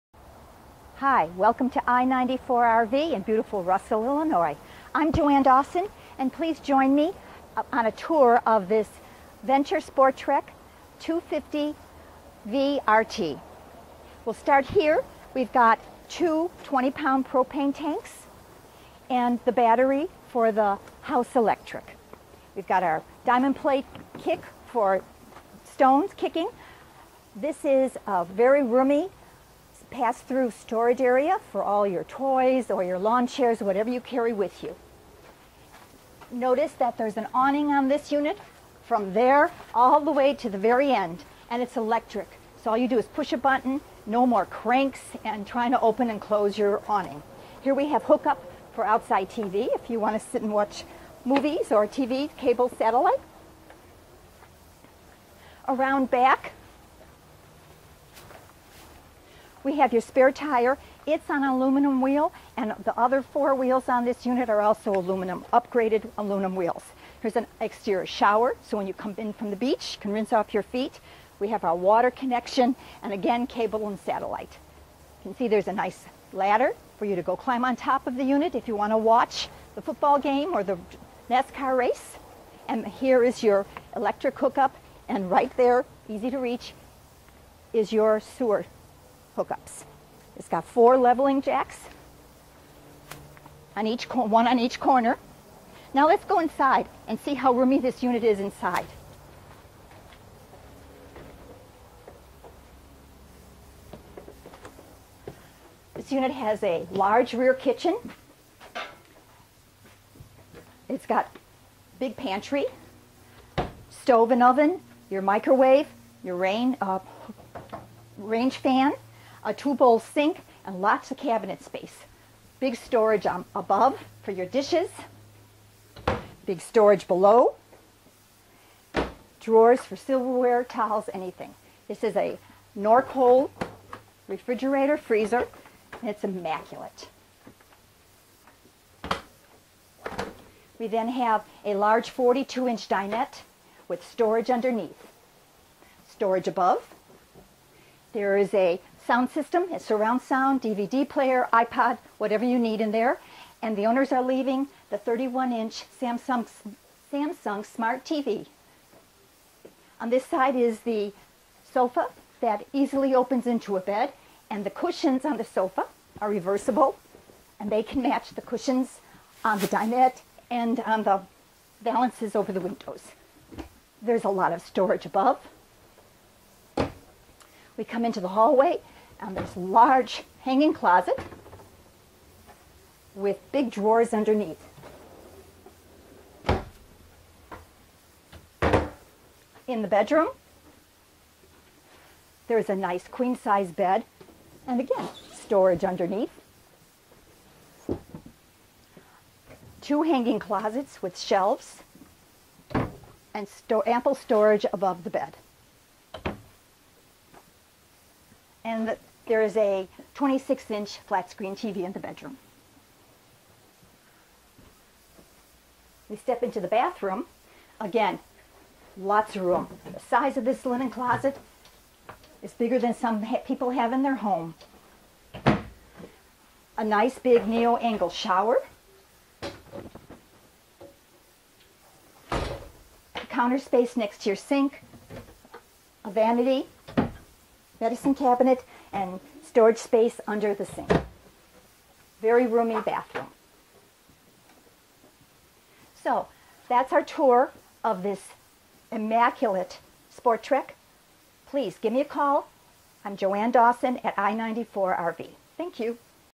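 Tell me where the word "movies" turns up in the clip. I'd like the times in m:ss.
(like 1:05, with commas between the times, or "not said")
0:51.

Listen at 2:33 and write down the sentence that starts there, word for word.
And the owners are leaving the 31-inch Samsung, Samsung Smart TV.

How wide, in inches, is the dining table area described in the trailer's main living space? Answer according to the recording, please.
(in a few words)
42.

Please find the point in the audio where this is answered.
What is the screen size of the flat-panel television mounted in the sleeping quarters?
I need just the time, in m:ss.
3:30.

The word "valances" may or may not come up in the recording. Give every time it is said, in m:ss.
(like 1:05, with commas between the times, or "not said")
2:51.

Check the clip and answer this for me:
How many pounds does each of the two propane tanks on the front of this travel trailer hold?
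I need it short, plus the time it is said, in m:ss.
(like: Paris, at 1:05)
20, at 0:16.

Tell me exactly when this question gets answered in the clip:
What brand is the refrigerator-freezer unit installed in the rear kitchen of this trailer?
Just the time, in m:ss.
2:12.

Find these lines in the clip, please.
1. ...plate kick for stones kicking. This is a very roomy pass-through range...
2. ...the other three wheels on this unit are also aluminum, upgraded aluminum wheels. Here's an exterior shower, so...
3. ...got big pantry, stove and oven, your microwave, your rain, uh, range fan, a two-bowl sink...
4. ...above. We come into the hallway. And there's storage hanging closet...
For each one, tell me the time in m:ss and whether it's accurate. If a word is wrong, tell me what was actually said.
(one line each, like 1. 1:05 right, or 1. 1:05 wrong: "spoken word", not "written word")
1. 0:23 wrong: "storage", not "range"
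2. 1:02 wrong: "four", not "three"
3. 1:51 right
4. 2:55 wrong: "large", not "storage".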